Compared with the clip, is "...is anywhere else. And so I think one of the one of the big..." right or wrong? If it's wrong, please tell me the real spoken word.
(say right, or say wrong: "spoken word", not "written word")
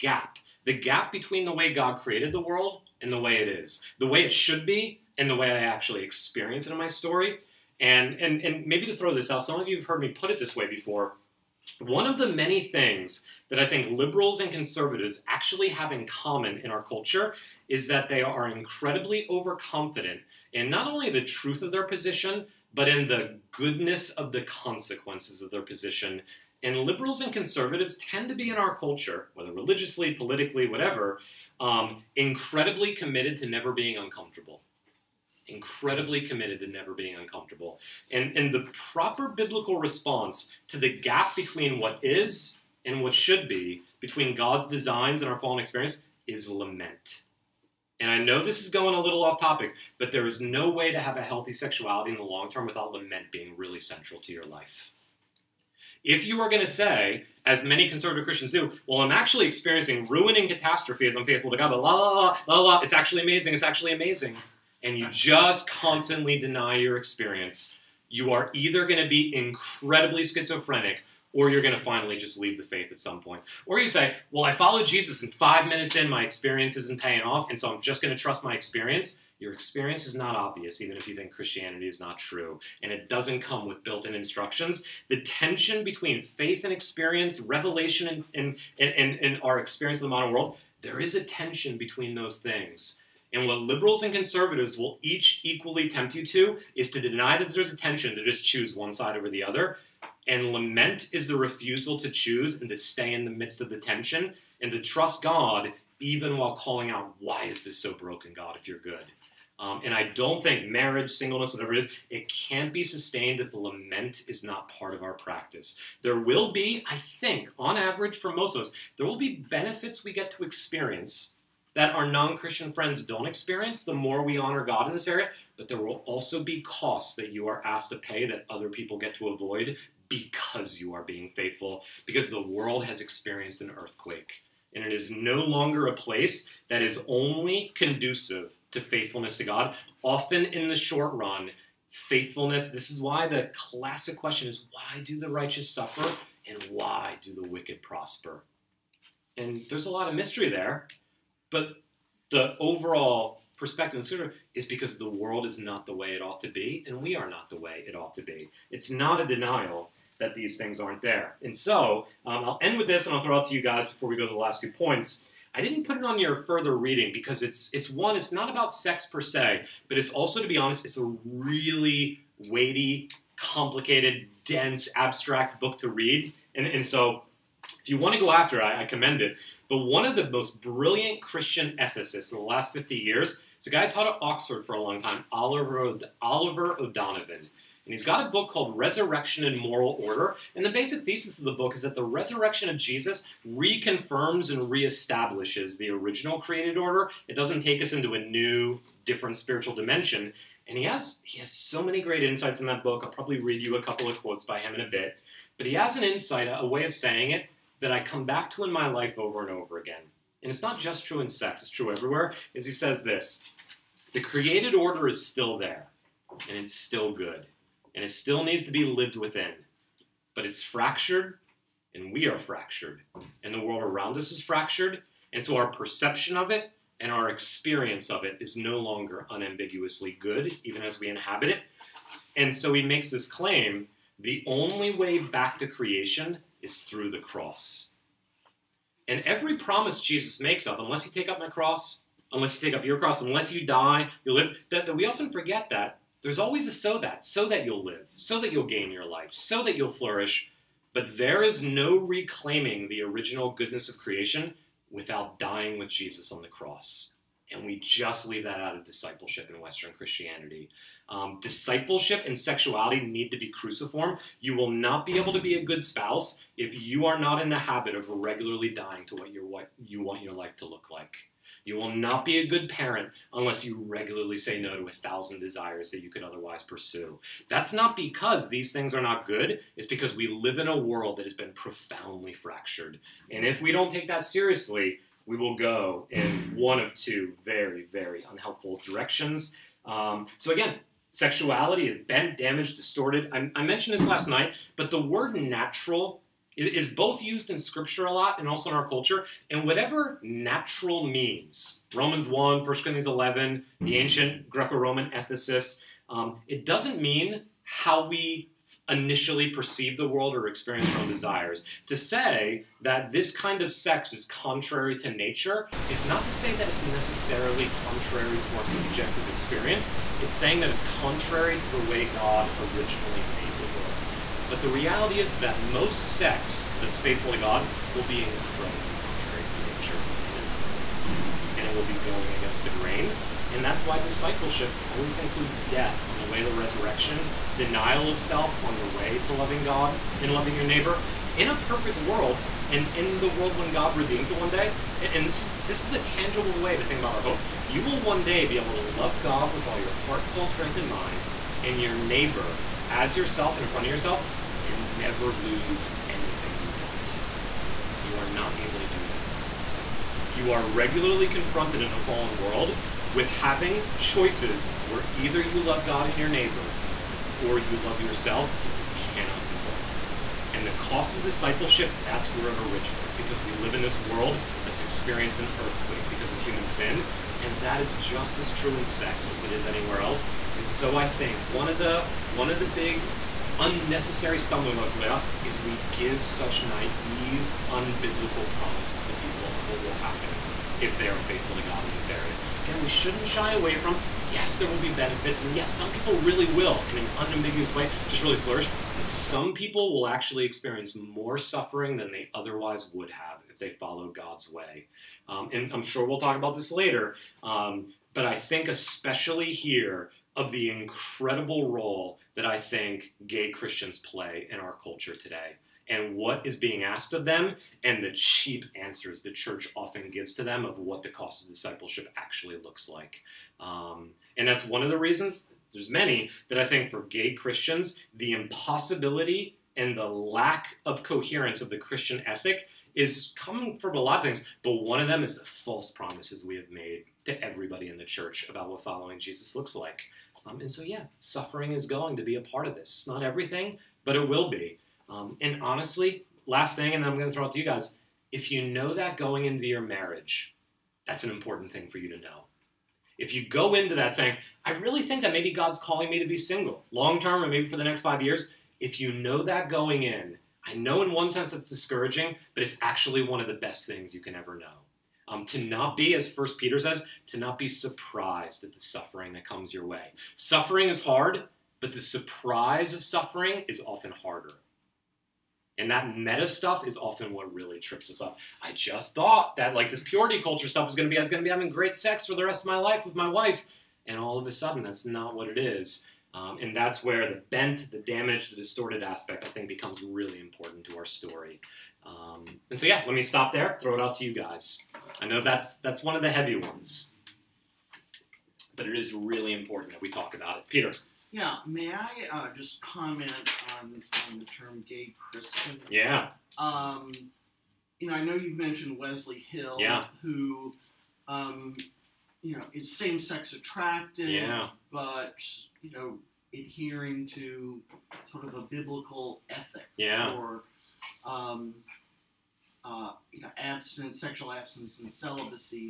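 right.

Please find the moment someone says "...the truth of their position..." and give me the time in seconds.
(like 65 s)
21 s.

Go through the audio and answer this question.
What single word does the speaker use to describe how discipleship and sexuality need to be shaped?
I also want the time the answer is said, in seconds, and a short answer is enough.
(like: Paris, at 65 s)
Cruciform, at 263 s.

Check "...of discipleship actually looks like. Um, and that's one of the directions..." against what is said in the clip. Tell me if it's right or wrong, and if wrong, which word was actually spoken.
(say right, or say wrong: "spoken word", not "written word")
wrong: "reasons", not "directions".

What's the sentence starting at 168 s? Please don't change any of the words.
It's not about sex per se, but it's also, to be honest, it's a really weighty, complicated, dense, abstract book to read.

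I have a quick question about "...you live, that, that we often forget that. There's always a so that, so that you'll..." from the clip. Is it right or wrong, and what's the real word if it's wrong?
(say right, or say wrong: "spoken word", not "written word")
right.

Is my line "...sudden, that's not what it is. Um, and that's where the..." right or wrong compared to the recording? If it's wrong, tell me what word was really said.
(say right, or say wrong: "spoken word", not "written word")
right.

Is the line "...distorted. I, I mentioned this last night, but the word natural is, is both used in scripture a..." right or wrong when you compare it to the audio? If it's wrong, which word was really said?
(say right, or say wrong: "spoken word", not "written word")
right.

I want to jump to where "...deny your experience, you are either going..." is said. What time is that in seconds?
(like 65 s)
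66 s.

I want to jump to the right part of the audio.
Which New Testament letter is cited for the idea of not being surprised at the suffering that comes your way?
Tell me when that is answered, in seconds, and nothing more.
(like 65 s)
466 s.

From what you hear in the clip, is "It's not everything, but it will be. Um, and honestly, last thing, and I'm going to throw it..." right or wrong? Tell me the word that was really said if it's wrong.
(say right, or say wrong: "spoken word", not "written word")
right.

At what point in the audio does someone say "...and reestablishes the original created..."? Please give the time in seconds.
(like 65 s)
194 s.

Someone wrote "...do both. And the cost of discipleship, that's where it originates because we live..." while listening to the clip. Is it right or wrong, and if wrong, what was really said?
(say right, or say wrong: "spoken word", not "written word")
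right.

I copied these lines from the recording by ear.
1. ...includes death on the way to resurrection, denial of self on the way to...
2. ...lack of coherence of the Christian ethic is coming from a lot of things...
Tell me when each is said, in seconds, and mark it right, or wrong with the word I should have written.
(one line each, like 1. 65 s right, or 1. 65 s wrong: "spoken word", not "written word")
1. 335 s right
2. 430 s right.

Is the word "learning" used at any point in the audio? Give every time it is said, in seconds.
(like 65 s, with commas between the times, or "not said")
not said.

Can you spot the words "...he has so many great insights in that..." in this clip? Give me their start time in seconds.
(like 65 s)
201 s.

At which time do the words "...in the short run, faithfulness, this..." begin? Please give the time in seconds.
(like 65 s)
140 s.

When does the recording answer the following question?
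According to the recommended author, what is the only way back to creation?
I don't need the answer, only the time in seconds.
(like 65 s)
236 s.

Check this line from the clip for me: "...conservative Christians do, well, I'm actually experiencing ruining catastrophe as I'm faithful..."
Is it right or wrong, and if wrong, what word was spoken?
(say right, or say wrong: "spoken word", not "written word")
right.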